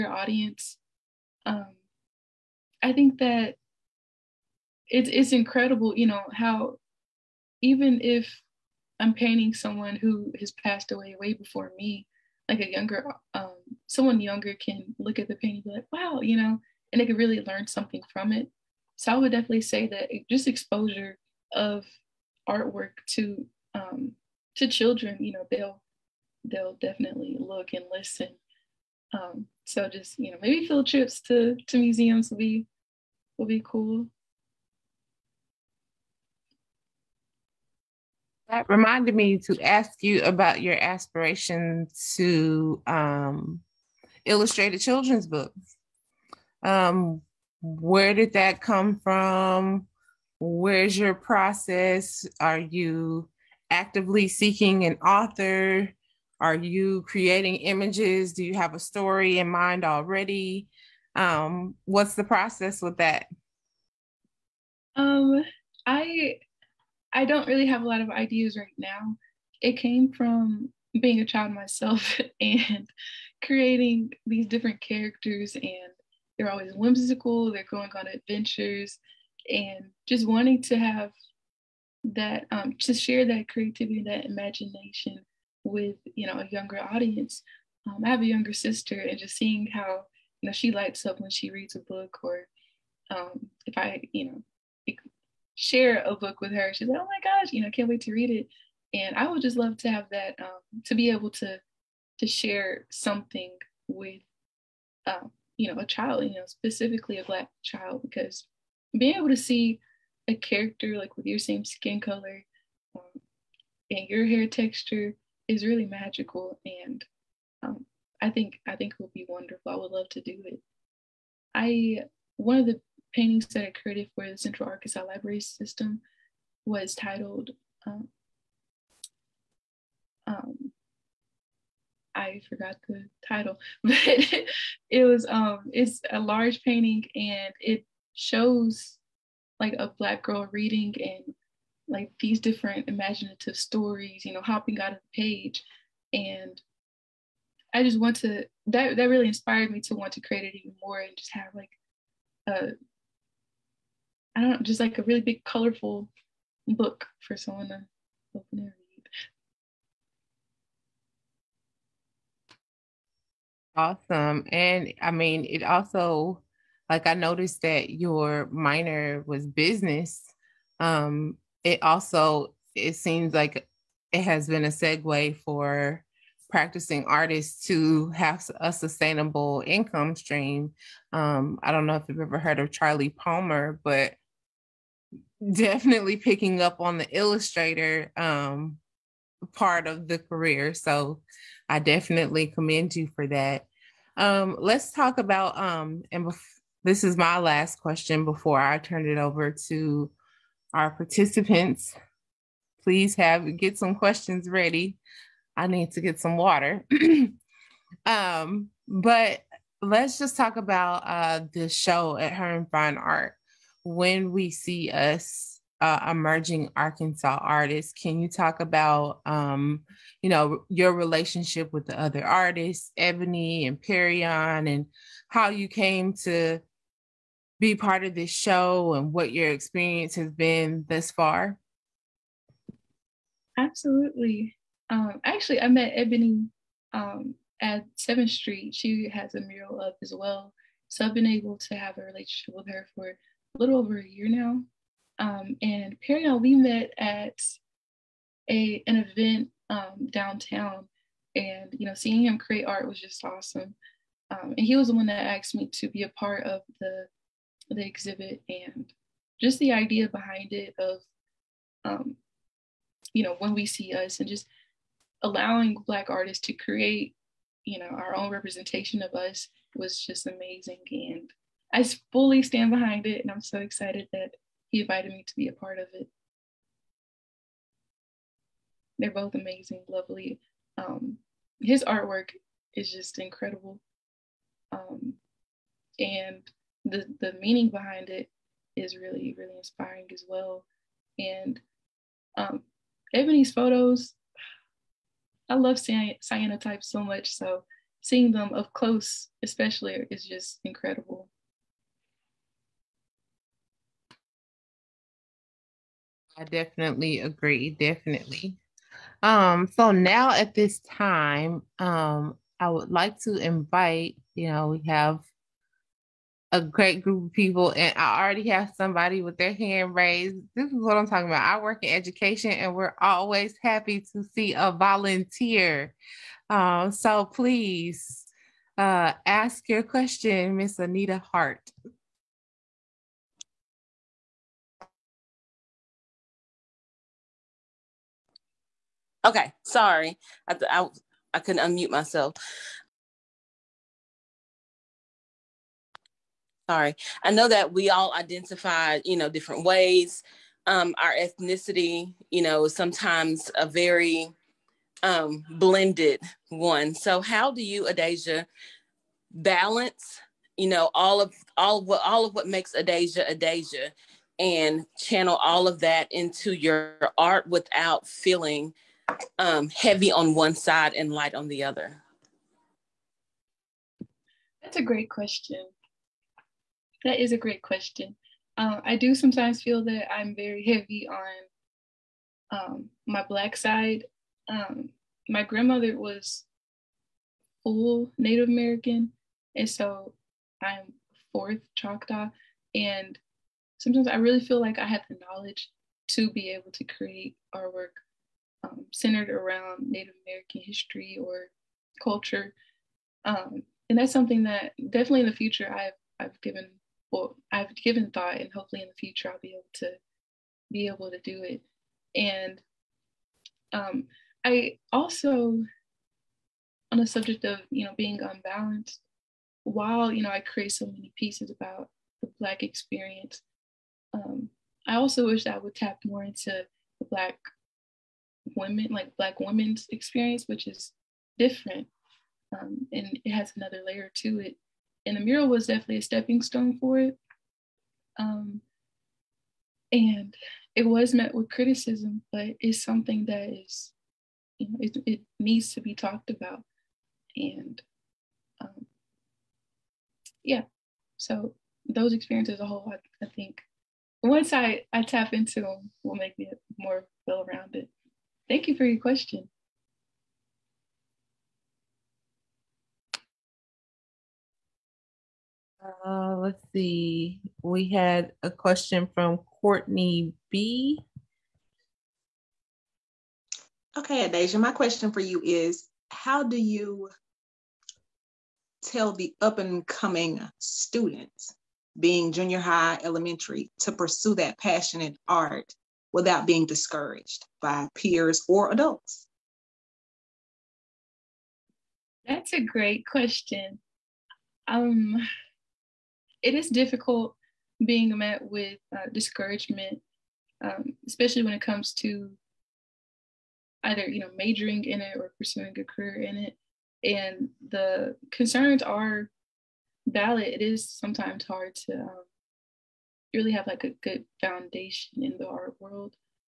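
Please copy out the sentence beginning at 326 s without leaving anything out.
Um, so please uh, ask your question, Miss Anita Hart.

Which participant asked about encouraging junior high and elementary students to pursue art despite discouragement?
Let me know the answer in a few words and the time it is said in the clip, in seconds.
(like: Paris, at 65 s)
Courtney B., at 469 s.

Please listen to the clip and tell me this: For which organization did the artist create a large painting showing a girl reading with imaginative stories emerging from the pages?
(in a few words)
Central Arkansas Library System.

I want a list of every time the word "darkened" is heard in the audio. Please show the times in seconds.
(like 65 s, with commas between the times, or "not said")
not said.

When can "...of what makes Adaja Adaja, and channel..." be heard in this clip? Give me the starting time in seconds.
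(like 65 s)
362 s.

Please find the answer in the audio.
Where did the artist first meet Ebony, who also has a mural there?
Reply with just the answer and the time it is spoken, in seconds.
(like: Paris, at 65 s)
7th Street, at 237 s.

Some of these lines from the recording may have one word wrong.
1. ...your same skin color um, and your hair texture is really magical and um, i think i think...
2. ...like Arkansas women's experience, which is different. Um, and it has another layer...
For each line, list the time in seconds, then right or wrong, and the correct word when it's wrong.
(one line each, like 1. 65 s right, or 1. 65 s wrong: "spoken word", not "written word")
1. 111 s right
2. 428 s wrong: "Black", not "Arkansas".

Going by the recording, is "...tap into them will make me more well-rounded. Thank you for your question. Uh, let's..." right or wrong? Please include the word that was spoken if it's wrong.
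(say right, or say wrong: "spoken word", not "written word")
right.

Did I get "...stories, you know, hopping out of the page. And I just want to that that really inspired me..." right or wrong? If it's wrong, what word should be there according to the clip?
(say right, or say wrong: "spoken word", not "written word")
right.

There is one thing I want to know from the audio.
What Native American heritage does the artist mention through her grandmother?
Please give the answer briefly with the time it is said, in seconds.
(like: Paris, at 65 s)
Choctaw, at 391 s.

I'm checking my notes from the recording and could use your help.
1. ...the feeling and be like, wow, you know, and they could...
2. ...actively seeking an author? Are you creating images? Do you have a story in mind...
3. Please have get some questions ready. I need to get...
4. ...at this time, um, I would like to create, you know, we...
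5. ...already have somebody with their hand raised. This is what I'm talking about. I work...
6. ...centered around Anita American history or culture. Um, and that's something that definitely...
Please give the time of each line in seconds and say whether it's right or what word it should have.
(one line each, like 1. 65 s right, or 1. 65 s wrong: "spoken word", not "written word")
1. 15 s wrong: "painting", not "feeling"
2. 53 s right
3. 202 s right
4. 310 s wrong: "invite", not "create"
5. 318 s right
6. 398 s wrong: "Native", not "Anita".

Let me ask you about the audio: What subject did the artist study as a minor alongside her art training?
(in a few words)
Business.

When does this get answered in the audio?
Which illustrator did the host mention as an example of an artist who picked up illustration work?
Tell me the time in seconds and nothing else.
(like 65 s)
182 s.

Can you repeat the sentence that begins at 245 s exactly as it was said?
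Um, and Perrion we met at a an event um, downtown, and you know, seeing him create art was just awesome.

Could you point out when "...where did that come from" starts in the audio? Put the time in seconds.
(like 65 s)
47 s.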